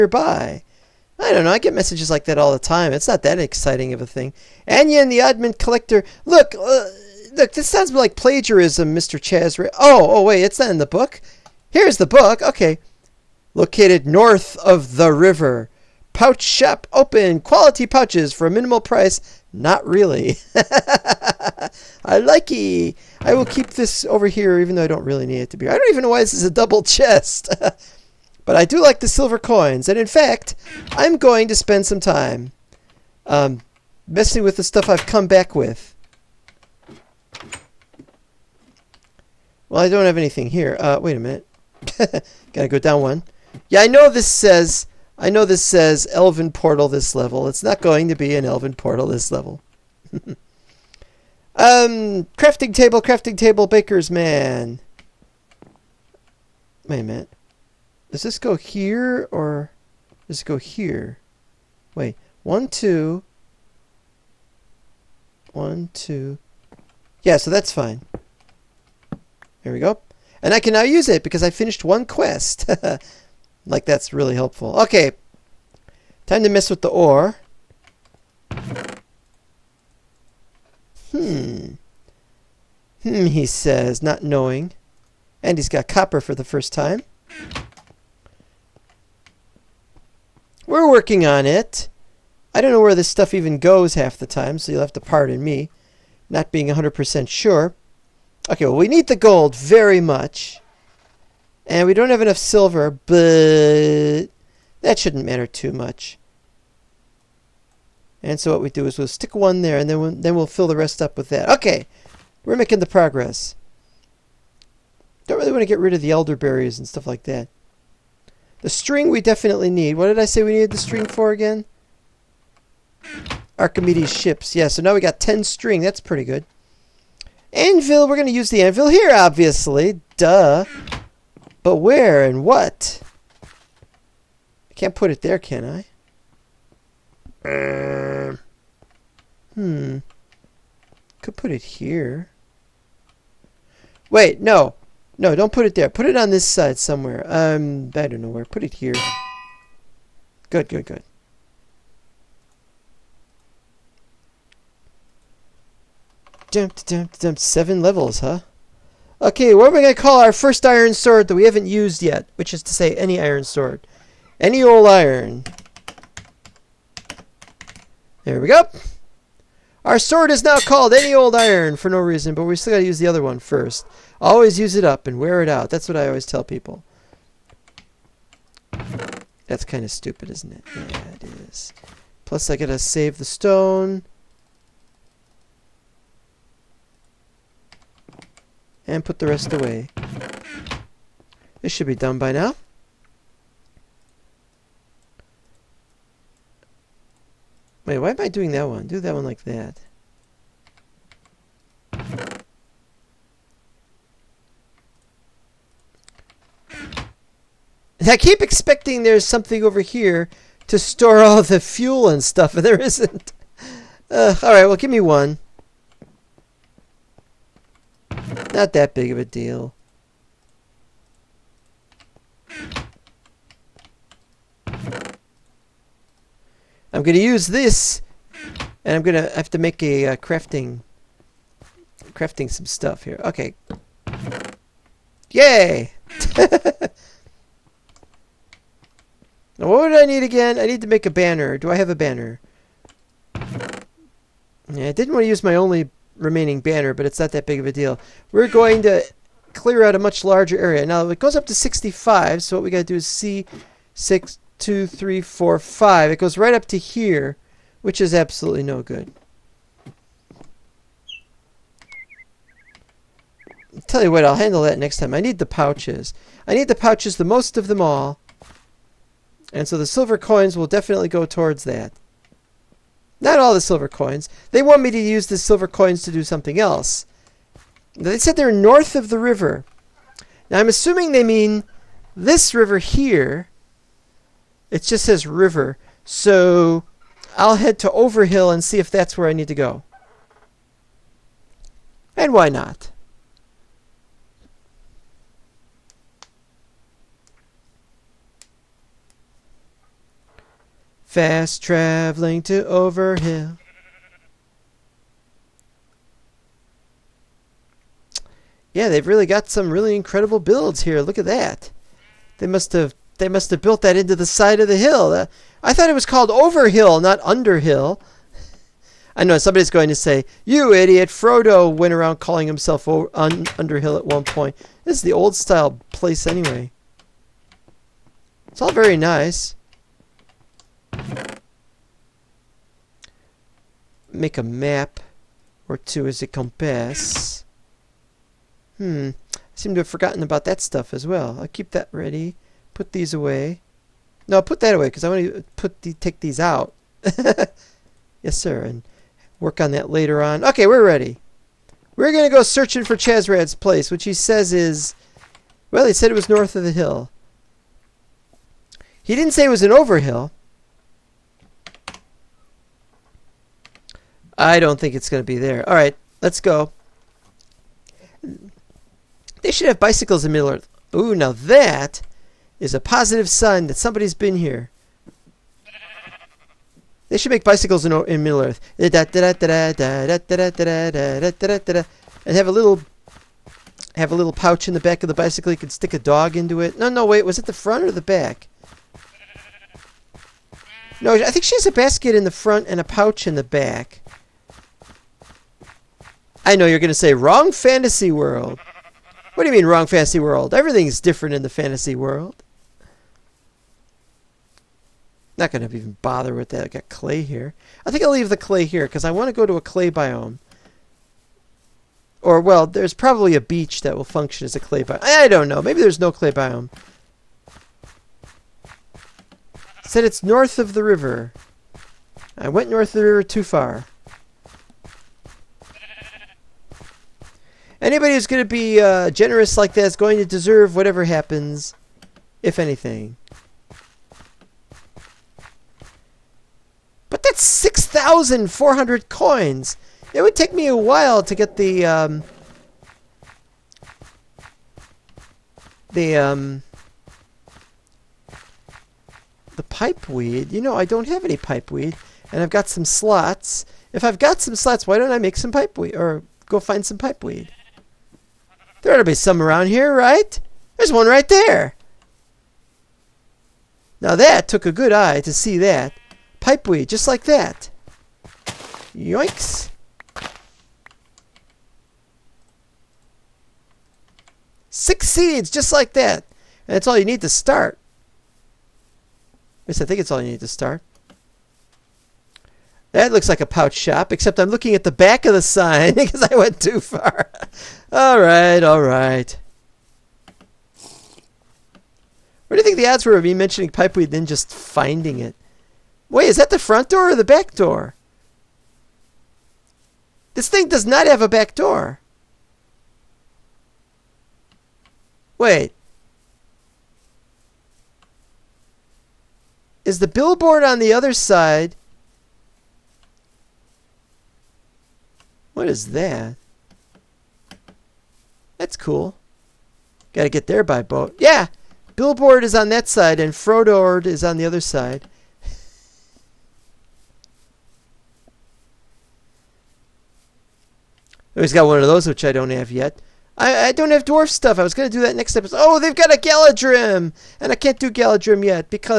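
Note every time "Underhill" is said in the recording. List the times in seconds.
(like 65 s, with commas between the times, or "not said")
317 s, 323 s.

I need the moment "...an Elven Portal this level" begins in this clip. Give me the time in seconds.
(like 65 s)
48 s.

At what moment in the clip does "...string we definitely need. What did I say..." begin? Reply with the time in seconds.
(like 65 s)
118 s.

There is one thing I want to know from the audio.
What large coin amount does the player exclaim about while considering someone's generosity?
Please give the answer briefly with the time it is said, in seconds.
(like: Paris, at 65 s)
6,400 coins, at 437 s.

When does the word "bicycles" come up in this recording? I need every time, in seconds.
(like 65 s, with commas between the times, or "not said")
369 s, 377 s, 385 s.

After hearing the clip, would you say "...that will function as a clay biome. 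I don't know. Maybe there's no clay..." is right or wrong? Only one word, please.
right.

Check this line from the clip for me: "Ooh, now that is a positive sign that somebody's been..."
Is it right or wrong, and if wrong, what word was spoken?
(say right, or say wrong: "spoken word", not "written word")
right.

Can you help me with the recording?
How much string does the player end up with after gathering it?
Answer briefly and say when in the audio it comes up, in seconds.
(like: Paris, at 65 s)
10, at 125 s.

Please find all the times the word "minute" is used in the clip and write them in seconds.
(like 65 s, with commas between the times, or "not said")
41 s, 57 s.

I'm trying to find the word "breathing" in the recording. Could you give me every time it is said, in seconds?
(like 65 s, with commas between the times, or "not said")
not said.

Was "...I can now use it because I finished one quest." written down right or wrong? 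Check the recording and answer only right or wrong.
right.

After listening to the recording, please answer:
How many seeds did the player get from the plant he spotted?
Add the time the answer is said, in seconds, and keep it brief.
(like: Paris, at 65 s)
6, at 474 s.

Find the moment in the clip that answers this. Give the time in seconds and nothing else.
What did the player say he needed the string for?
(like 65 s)
123 s.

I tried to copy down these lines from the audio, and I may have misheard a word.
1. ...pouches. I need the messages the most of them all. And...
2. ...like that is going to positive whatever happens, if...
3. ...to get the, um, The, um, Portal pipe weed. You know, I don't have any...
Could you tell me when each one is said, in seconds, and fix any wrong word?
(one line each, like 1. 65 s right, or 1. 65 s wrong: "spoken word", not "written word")
1. 265 s wrong: "pouches", not "messages"
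2. 429 s wrong: "deserve", not "positive"
3. 441 s wrong: "The", not "Portal".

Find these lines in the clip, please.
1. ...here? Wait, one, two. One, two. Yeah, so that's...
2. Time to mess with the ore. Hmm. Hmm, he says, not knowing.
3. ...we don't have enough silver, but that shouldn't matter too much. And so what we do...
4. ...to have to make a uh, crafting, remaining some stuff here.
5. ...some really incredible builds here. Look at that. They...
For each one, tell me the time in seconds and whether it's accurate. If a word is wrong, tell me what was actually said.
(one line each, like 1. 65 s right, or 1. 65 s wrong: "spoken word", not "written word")
1. 60 s right
2. 76 s right
3. 101 s right
4. 229 s wrong: "crafting", not "remaining"
5. 309 s right.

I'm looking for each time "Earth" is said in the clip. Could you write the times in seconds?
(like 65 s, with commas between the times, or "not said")
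370 s, 378 s.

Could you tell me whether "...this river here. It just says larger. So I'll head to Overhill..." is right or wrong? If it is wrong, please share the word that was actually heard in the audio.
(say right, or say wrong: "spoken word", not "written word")
wrong: "river", not "larger".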